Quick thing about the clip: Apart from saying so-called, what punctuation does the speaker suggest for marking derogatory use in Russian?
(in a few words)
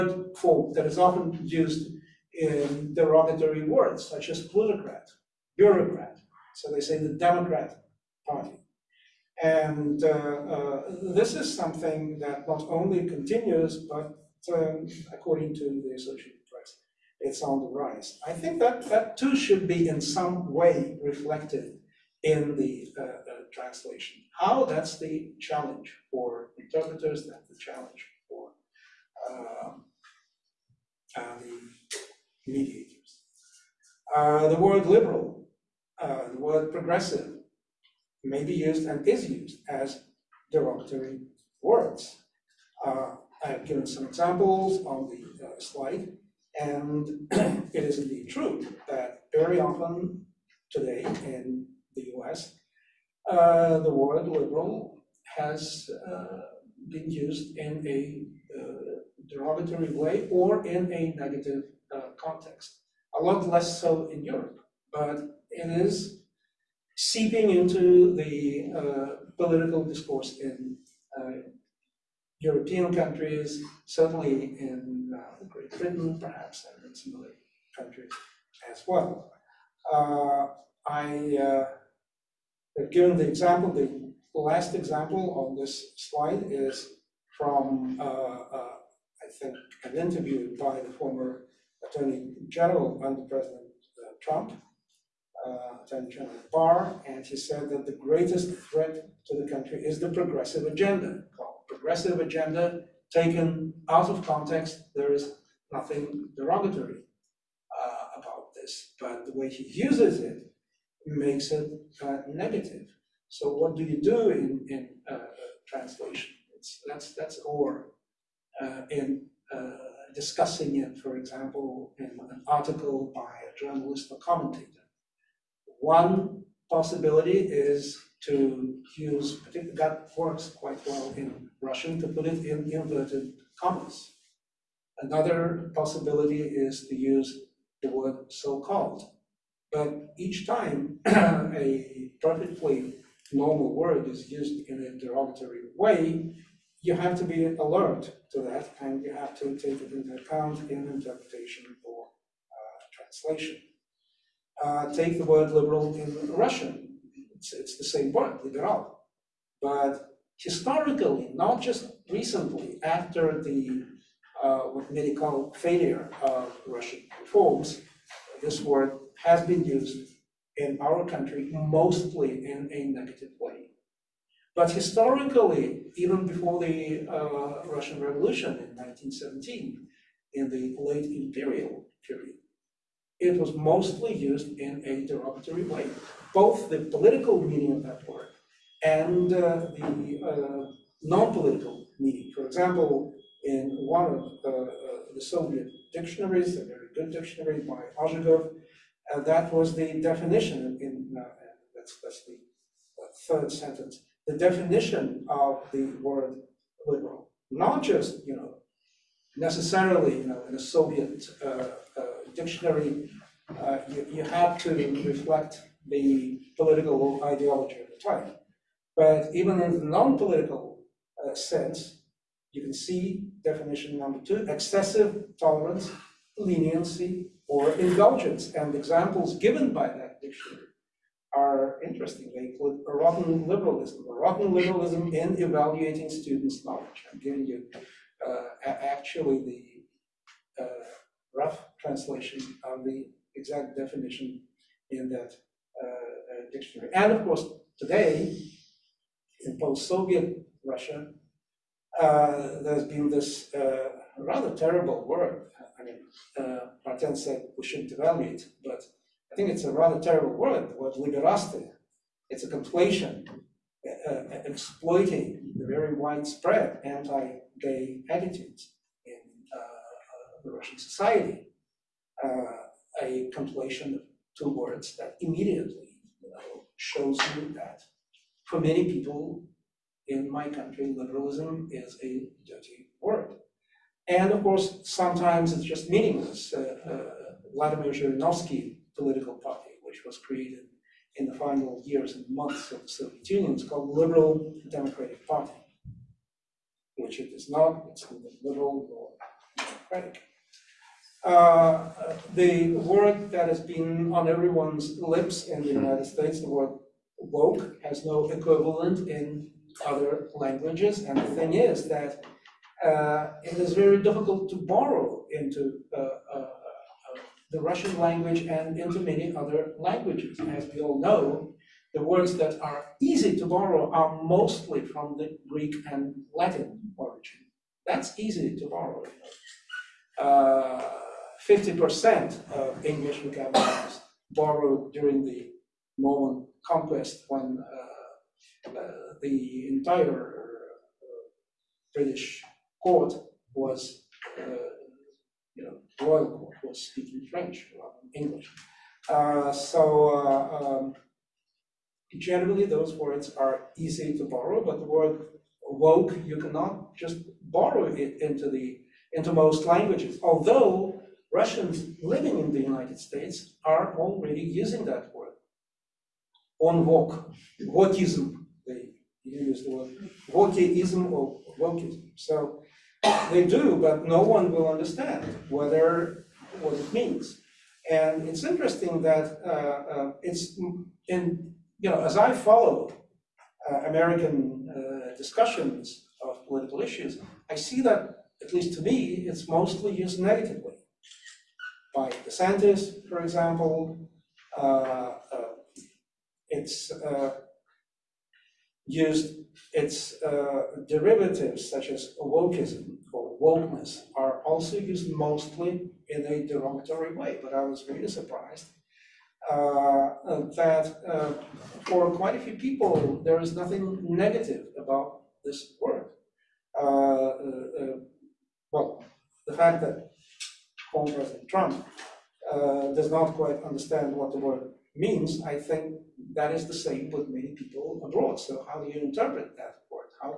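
inverted commas.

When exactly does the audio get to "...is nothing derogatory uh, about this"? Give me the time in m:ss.
1:45.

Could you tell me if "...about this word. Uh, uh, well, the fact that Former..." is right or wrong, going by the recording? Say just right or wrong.
right.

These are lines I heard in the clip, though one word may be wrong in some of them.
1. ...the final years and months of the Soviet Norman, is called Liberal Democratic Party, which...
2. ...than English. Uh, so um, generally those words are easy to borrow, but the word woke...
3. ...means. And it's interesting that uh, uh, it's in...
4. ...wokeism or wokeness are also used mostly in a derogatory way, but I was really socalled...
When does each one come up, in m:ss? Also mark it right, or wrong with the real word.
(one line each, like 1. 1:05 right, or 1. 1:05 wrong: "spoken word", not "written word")
1. 4:51 wrong: "Union", not "Norman"
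2. 5:48 right
3. 6:16 right
4. 6:42 wrong: "surprised", not "socalled".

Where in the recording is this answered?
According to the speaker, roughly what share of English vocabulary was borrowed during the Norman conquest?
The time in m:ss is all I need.
5:31.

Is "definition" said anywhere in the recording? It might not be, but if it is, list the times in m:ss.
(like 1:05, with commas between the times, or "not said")
3:20, 3:24, 3:43, 4:03.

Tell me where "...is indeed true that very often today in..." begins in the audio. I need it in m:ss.
0:47.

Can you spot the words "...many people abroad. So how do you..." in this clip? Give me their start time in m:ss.
7:07.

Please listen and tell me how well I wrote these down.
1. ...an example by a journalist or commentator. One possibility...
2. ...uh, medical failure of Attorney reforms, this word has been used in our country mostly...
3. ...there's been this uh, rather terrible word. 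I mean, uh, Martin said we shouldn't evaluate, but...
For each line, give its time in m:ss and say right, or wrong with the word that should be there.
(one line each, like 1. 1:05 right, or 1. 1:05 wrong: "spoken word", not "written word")
1. 2:02 wrong: "article", not "example"
2. 2:44 wrong: "Russian", not "Attorney"
3. 4:12 right.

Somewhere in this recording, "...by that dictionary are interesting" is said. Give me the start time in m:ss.
3:49.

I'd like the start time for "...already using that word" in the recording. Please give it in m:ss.
6:03.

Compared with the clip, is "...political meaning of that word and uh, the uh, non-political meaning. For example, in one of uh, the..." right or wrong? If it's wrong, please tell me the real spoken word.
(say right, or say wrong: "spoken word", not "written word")
right.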